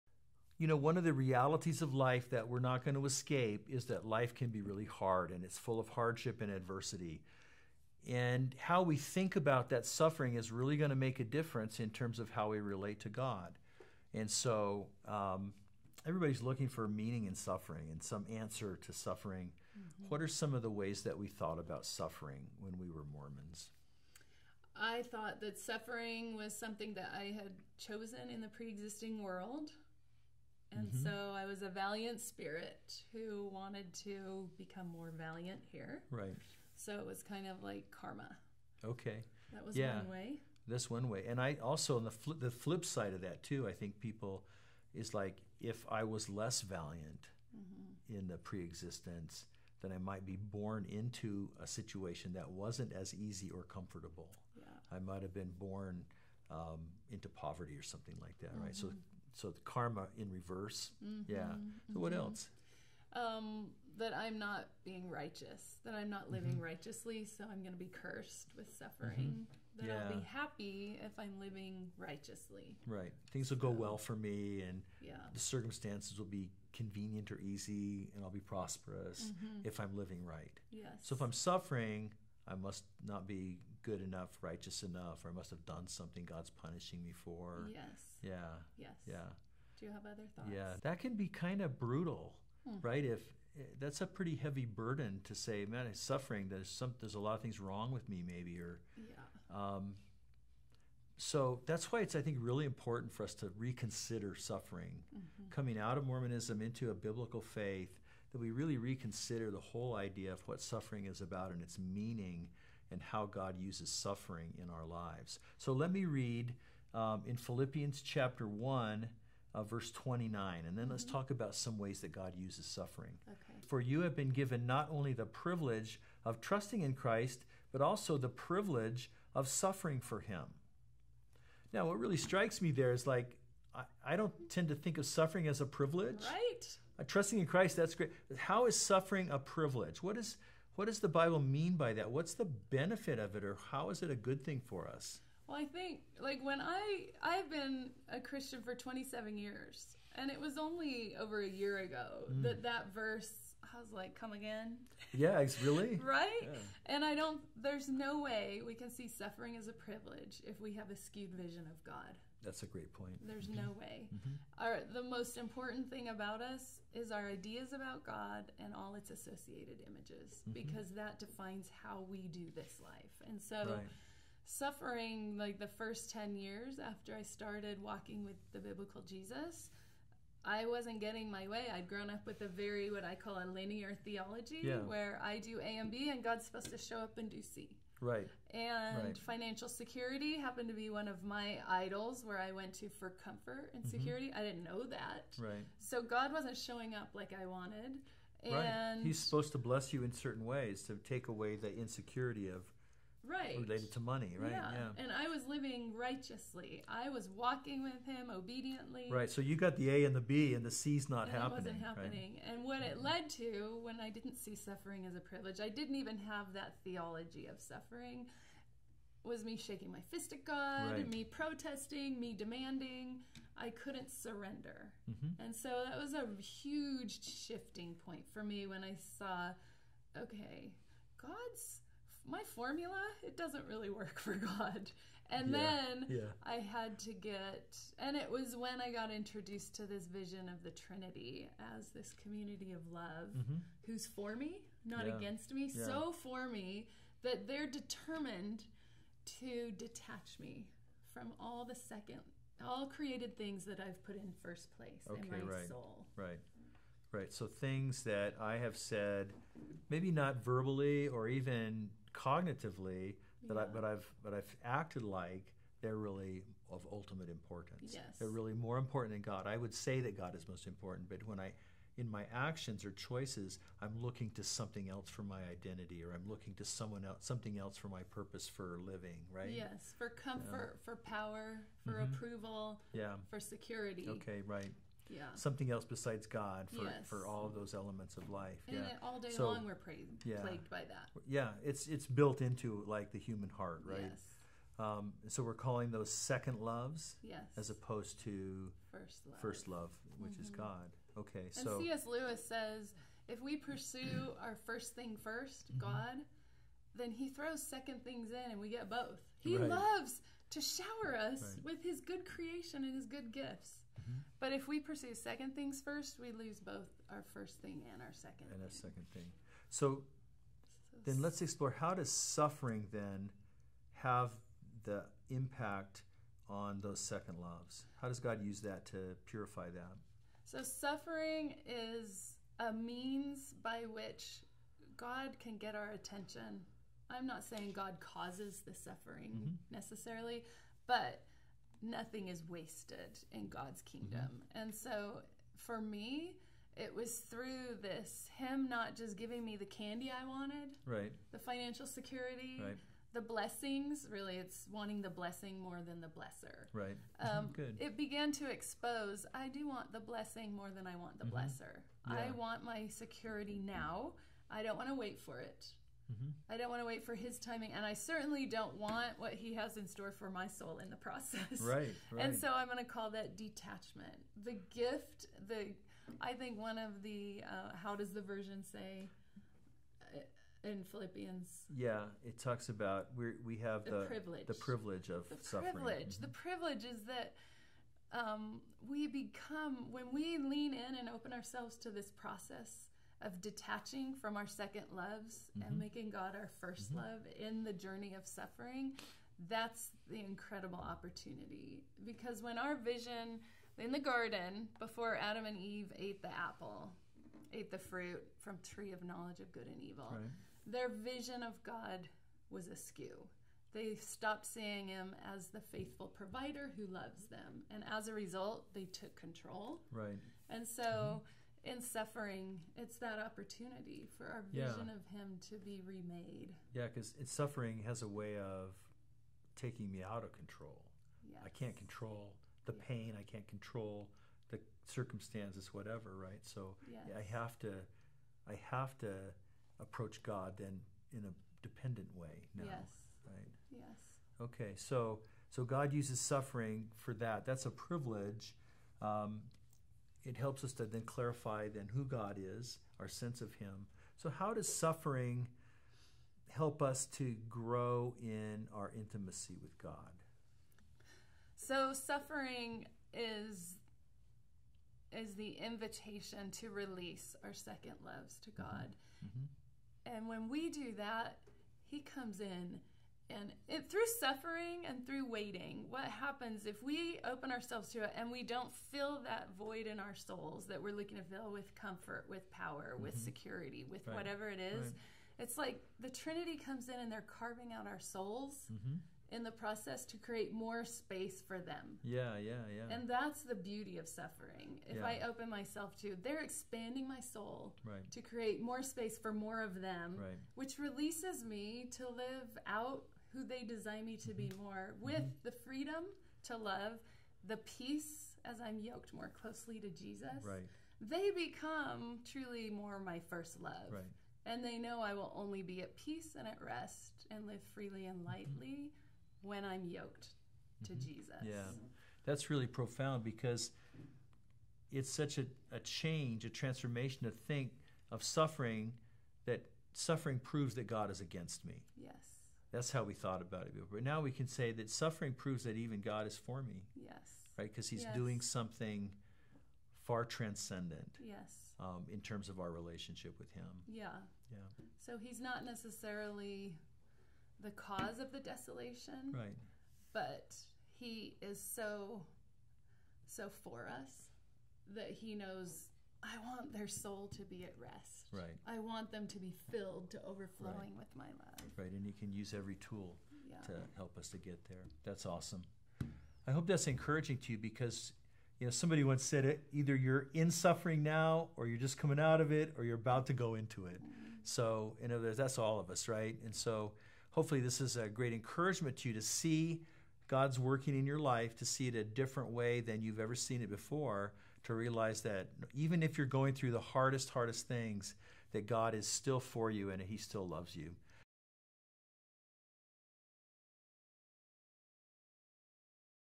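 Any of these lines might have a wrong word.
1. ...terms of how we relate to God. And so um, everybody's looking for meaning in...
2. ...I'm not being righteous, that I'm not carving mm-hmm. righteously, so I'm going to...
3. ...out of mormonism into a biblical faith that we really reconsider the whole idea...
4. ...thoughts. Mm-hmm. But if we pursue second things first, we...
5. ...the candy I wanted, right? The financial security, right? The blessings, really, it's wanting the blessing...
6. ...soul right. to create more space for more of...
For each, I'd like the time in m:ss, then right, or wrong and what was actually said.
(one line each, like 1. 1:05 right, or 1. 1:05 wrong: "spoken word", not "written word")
1. 0:11 right
2. 1:04 wrong: "living", not "carving"
3. 1:45 right
4. 5:13 wrong: "gifts", not "thoughts"
5. 5:49 right
6. 8:17 right.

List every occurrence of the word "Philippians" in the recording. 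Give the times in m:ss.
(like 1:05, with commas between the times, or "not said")
1:57, 6:20.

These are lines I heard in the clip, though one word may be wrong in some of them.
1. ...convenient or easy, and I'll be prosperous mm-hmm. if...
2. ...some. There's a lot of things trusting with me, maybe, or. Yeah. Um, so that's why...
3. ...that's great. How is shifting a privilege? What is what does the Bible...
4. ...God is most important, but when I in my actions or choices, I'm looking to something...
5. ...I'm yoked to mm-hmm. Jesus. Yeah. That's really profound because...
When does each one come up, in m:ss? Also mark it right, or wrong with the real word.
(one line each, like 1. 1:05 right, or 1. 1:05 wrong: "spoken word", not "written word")
1. 1:16 right
2. 1:36 wrong: "wrong", not "trusting"
3. 2:17 wrong: "suffering", not "shifting"
4. 4:30 right
5. 8:39 right.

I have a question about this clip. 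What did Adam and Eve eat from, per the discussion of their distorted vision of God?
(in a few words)
tree of knowledge of good and evil.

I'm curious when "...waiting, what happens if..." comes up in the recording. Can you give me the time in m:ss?
7:55.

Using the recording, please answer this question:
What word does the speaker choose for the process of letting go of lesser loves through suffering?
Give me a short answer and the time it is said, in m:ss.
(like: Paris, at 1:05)
detachment, at 6:13.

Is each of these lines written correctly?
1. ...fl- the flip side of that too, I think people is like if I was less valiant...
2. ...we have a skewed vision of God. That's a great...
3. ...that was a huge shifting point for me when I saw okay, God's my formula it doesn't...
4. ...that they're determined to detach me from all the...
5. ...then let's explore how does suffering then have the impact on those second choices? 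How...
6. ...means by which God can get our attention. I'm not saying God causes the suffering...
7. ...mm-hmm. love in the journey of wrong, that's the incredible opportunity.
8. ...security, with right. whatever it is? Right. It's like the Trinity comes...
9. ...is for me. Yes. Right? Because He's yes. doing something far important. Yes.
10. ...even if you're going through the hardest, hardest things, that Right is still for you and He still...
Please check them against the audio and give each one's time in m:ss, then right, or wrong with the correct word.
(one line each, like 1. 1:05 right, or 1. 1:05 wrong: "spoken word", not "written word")
1. 0:42 right
2. 2:40 right
3. 3:45 right
4. 4:07 right
5. 5:21 wrong: "loves", not "choices"
6. 5:32 right
7. 6:36 wrong: "suffering", not "wrong"
8. 8:03 right
9. 8:56 wrong: "transcendent", not "important"
10. 9:45 wrong: "God", not "Right".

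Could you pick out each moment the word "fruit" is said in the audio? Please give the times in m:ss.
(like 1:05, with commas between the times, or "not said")
6:47.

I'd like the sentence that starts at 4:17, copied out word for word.
So things that I have said, maybe not verbally or even cognitively, that yeah.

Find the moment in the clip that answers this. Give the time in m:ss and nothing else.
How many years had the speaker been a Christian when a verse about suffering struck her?
2:28.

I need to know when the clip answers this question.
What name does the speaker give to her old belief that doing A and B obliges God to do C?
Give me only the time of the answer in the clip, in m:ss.
3:03.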